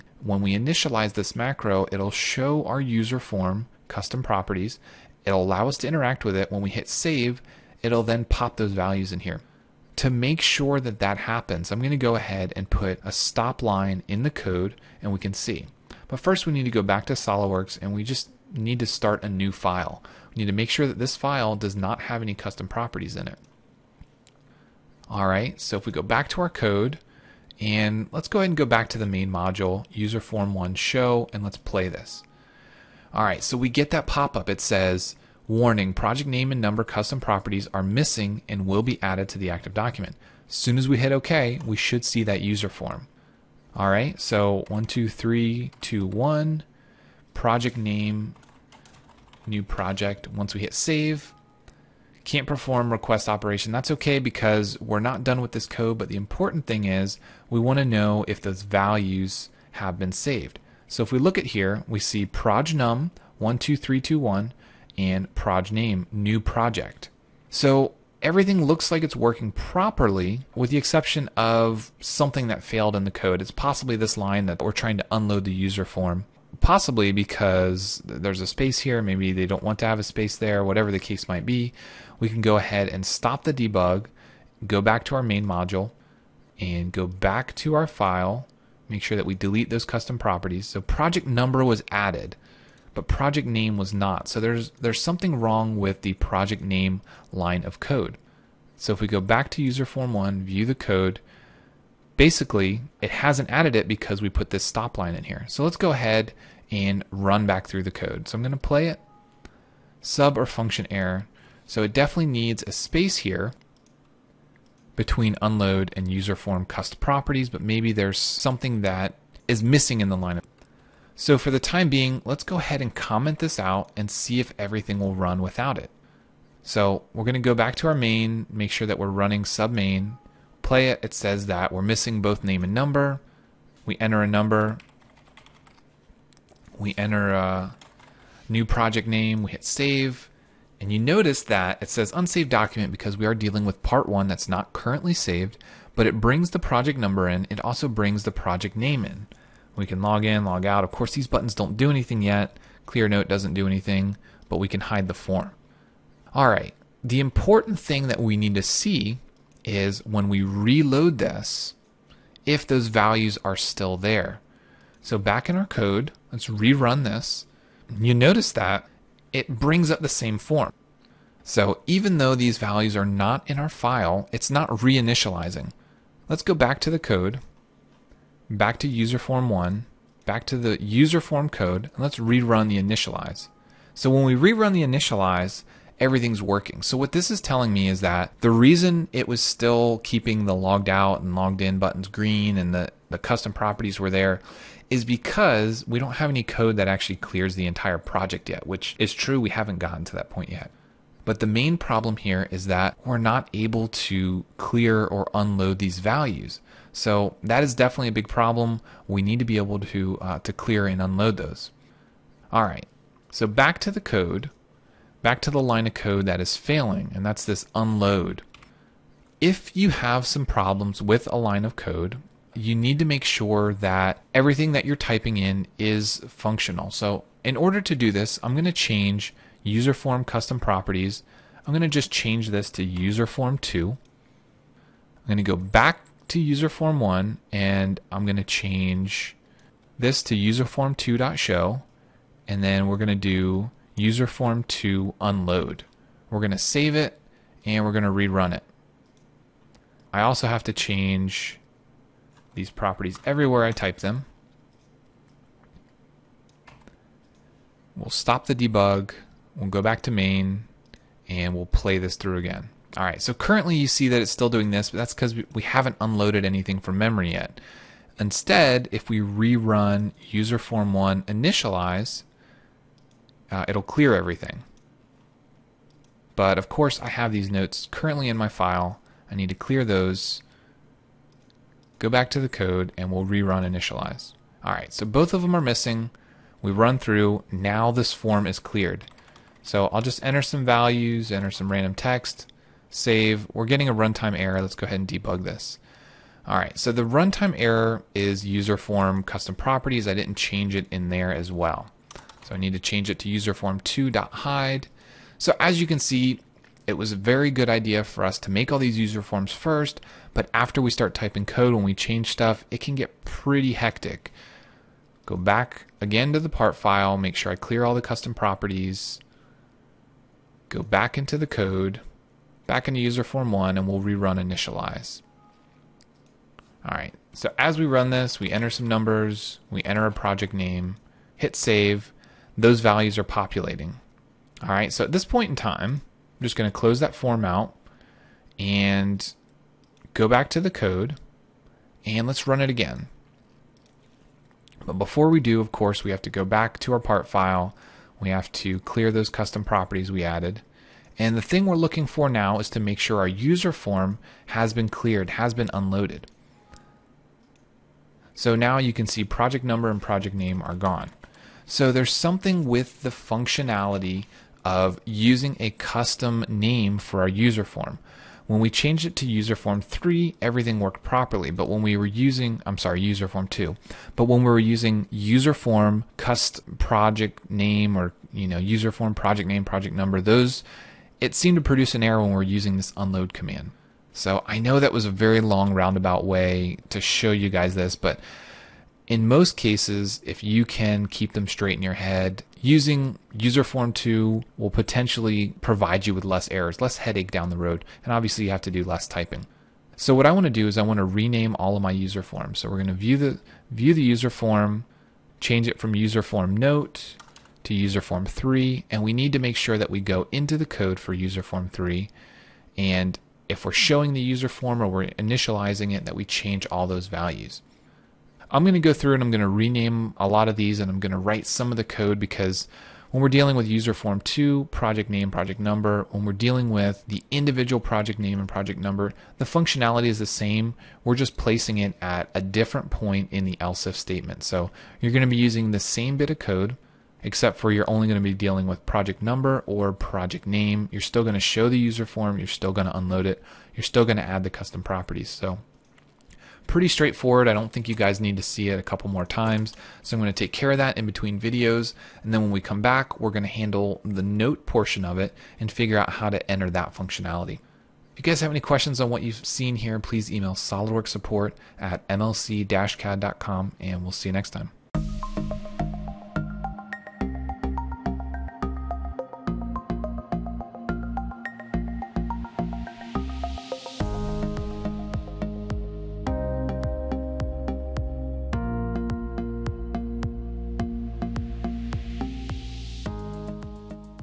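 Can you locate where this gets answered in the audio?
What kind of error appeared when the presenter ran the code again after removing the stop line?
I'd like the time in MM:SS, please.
01:50.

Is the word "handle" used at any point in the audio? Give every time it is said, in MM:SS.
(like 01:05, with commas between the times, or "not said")
07:33.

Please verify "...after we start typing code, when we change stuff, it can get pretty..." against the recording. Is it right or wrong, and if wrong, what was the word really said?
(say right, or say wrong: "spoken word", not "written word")
right.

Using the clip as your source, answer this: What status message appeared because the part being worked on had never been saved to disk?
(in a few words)
unsaved document.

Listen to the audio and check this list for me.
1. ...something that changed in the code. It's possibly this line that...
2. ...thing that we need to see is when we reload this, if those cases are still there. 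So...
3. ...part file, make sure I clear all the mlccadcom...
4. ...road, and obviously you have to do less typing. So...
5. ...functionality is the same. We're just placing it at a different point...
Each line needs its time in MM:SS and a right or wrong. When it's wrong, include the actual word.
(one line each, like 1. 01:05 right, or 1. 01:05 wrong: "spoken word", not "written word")
1. 01:11 wrong: "failed", not "changed"
2. 02:37 wrong: "values", not "cases"
3. 05:16 wrong: "custom", not "mlccadcom"
4. 06:37 right
5. 07:09 right.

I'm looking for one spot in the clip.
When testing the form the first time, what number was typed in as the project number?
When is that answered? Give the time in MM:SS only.
01:03.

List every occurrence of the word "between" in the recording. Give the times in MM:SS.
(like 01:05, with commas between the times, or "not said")
01:54, 07:31.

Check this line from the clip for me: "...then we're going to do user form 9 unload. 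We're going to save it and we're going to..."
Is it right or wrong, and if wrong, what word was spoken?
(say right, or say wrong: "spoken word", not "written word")
wrong: "2", not "9".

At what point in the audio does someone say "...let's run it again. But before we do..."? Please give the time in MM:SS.
05:42.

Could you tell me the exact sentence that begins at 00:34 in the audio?
It says, Warning, project name and number custom properties are missing and will be added to the active document.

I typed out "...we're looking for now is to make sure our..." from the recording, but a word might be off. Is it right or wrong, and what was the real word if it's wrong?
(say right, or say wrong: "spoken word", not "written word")
right.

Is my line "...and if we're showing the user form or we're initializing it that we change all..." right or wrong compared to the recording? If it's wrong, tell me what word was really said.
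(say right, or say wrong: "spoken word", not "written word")
right.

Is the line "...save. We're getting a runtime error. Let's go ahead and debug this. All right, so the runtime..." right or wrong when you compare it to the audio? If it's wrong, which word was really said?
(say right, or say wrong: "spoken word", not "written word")
right.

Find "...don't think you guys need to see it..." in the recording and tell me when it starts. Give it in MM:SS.
07:27.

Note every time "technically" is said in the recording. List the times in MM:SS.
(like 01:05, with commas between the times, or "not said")
not said.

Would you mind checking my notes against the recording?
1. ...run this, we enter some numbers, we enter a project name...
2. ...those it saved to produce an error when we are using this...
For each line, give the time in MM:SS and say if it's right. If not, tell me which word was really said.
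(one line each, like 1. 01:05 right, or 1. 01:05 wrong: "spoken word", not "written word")
1. 05:27 right
2. 06:20 wrong: "seemed", not "saved".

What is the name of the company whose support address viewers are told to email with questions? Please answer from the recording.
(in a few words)
SolidWorks support.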